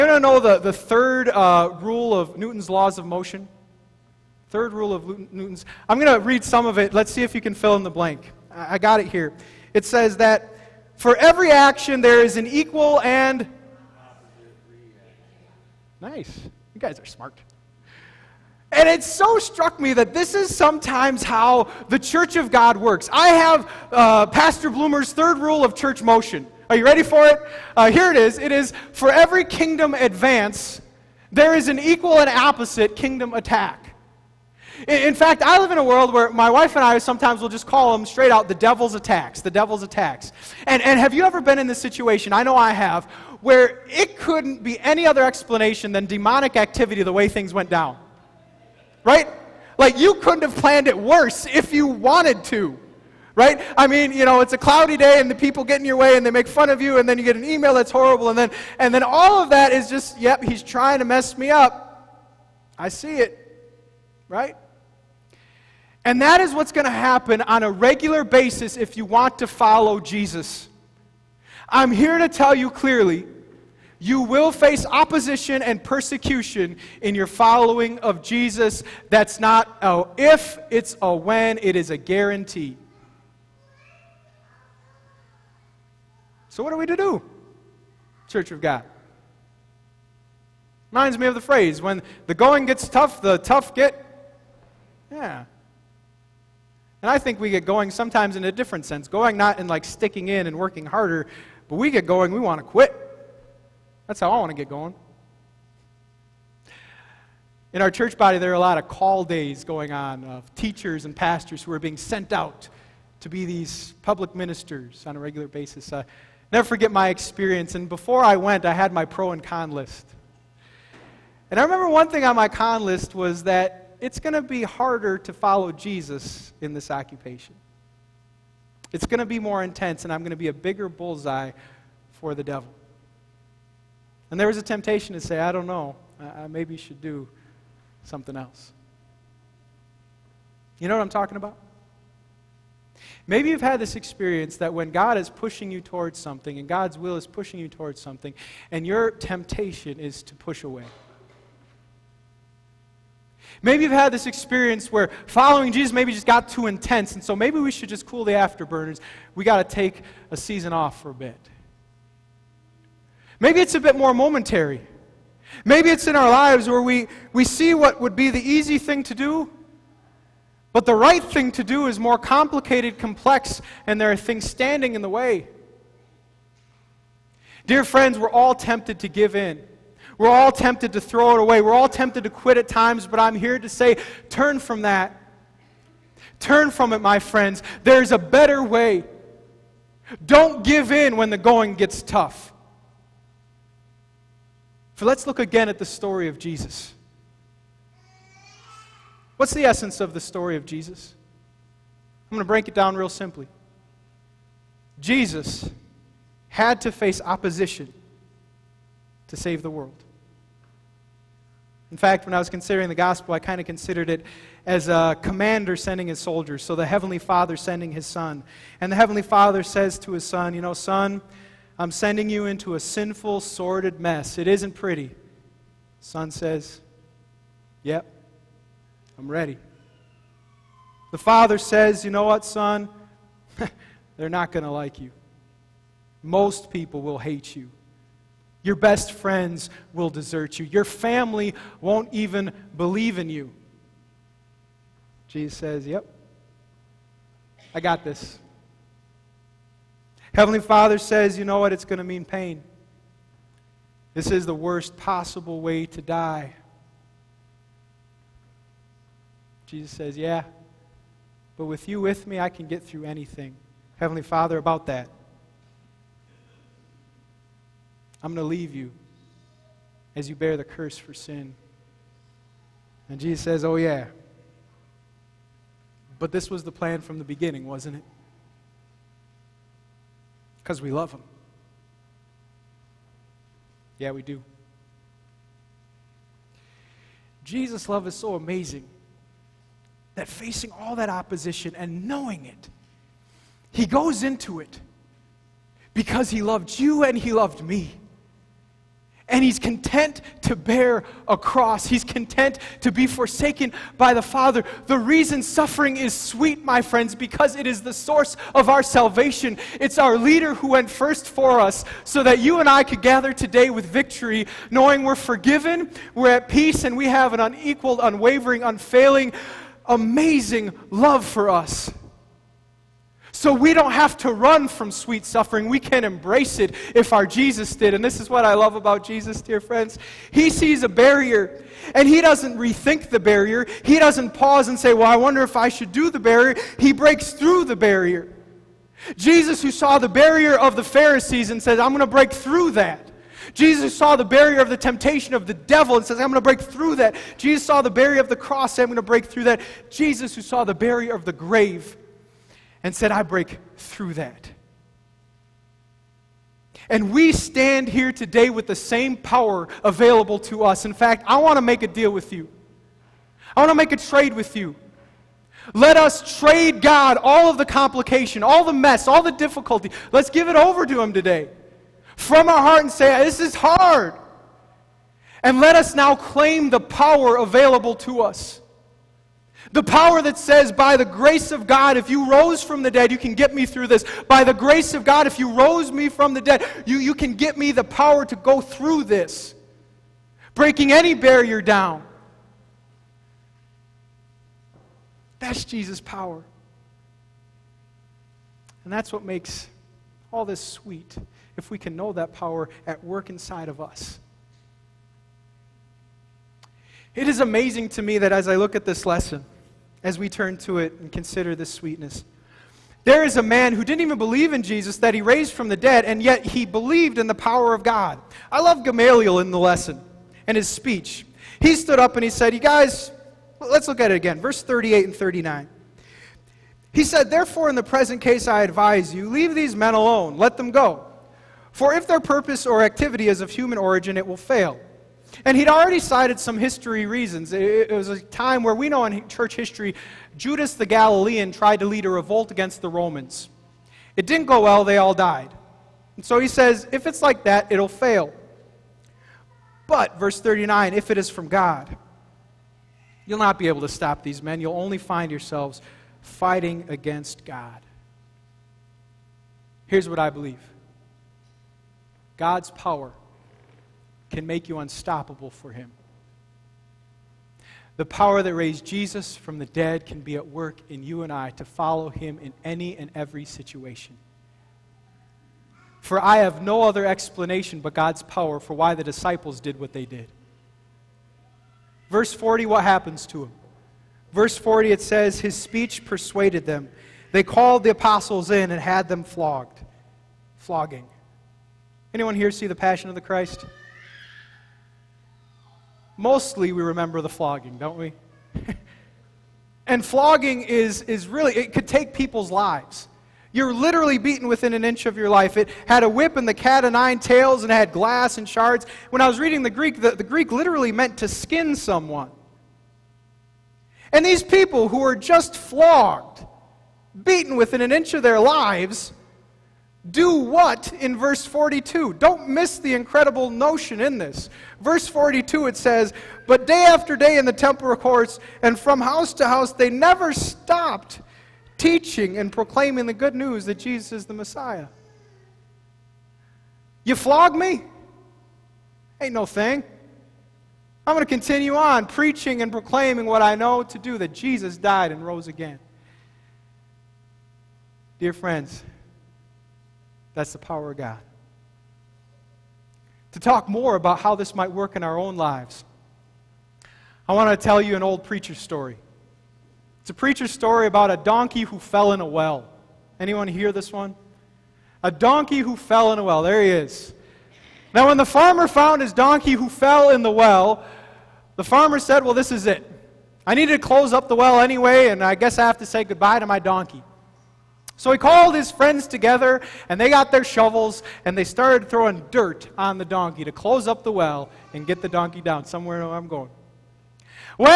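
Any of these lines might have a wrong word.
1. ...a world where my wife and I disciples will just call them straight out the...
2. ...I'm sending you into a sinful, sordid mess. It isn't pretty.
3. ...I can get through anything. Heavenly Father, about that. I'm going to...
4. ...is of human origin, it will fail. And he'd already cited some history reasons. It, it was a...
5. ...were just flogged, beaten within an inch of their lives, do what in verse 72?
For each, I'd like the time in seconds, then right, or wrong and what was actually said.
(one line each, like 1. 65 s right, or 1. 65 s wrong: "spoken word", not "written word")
1. 35 s wrong: "sometimes", not "disciples"
2. 221 s right
3. 262 s right
4. 433 s right
5. 514 s wrong: "42", not "72".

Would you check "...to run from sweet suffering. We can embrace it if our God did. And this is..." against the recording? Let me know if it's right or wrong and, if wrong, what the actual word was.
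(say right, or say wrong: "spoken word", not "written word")
wrong: "Jesus", not "God".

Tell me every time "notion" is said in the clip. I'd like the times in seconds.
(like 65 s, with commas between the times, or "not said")
523 s.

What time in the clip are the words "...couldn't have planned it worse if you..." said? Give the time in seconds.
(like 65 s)
50 s.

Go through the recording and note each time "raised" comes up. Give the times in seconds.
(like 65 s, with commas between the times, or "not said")
415 s, 468 s.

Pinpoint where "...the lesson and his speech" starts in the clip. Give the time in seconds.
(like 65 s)
419 s.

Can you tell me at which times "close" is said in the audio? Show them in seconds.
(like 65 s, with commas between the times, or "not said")
573 s, 583 s.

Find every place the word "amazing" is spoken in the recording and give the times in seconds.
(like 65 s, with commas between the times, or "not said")
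288 s, 319 s, 407 s.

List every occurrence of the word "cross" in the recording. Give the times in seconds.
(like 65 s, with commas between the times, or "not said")
301 s, 348 s.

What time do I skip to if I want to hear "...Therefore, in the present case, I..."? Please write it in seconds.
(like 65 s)
427 s.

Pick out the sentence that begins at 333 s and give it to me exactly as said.
He doesn't pause and say, Well, I wonder if I should do the barrier.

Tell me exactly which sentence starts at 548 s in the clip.
Dear friends, that's the power of God.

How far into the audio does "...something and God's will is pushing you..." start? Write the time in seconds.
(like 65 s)
146 s.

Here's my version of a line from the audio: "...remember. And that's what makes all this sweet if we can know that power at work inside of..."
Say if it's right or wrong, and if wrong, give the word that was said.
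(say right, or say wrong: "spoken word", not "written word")
wrong: "power", not "remember".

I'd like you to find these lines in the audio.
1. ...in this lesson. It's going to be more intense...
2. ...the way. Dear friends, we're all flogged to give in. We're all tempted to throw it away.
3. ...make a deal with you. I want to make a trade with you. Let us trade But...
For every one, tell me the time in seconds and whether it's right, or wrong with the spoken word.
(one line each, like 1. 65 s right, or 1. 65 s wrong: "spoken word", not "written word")
1. 126 s wrong: "occupation", not "lesson"
2. 175 s wrong: "tempted", not "flogged"
3. 361 s wrong: "God", not "But".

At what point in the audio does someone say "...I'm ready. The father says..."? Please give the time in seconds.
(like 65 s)
229 s.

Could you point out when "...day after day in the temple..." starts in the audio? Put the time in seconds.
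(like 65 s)
526 s.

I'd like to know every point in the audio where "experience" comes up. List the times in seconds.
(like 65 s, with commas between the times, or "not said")
117 s, 143 s, 154 s.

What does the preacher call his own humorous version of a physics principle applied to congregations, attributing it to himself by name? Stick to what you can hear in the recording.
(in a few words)
Pastor Bloomer's third rule of church motion.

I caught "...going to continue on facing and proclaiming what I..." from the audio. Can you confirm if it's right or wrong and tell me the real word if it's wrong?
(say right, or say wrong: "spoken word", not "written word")
wrong: "preaching", not "facing".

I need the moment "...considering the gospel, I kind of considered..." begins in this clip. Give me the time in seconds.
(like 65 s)
212 s.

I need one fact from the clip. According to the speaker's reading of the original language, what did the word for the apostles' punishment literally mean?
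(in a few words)
skin someone.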